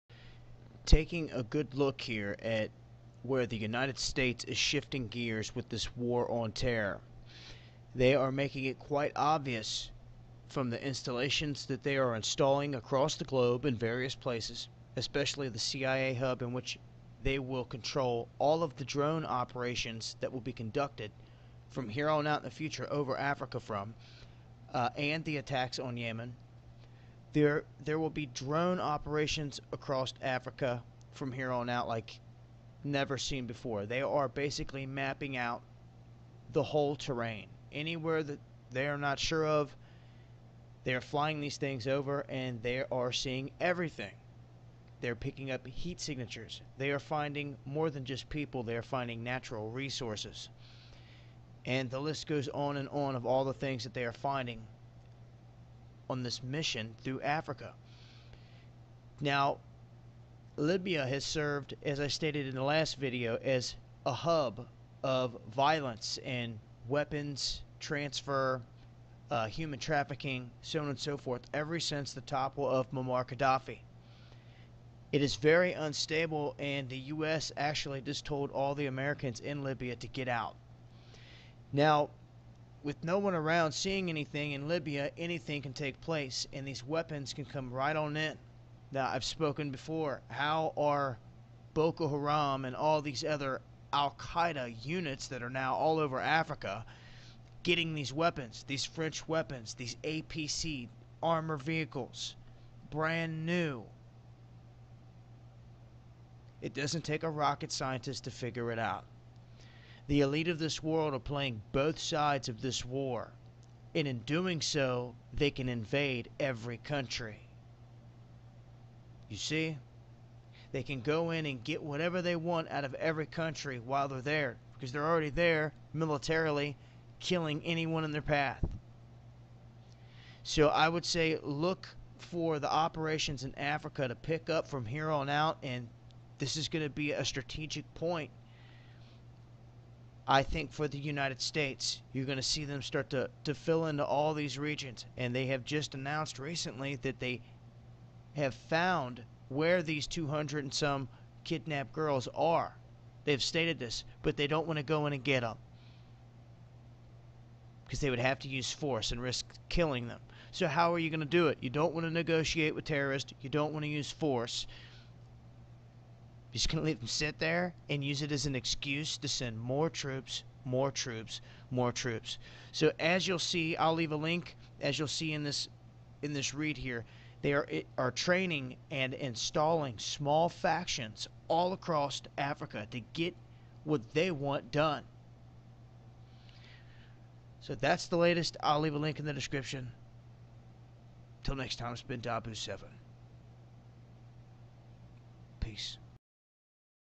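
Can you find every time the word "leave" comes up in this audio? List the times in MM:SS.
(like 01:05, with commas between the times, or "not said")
02:53, 03:08.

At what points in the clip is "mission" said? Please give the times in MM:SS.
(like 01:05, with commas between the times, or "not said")
00:56.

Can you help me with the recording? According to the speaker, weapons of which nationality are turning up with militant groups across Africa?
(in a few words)
French.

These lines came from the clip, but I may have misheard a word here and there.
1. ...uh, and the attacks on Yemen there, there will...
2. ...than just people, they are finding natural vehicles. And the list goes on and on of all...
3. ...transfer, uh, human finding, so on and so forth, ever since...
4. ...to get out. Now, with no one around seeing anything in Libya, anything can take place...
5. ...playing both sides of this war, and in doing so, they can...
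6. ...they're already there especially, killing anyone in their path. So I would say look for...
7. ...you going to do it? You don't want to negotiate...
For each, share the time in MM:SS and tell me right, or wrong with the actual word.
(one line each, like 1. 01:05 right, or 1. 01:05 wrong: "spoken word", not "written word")
1. 00:24 right
2. 00:47 wrong: "resources", not "vehicles"
3. 01:07 wrong: "trafficking", not "finding"
4. 01:19 right
5. 01:51 right
6. 02:04 wrong: "militarily", not "especially"
7. 02:40 right.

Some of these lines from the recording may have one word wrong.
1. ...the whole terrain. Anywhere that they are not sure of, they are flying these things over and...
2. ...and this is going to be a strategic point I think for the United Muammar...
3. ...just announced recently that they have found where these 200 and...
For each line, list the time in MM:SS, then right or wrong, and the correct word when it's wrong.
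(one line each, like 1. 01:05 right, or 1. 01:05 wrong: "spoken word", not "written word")
1. 00:36 right
2. 02:15 wrong: "States", not "Muammar"
3. 02:25 right.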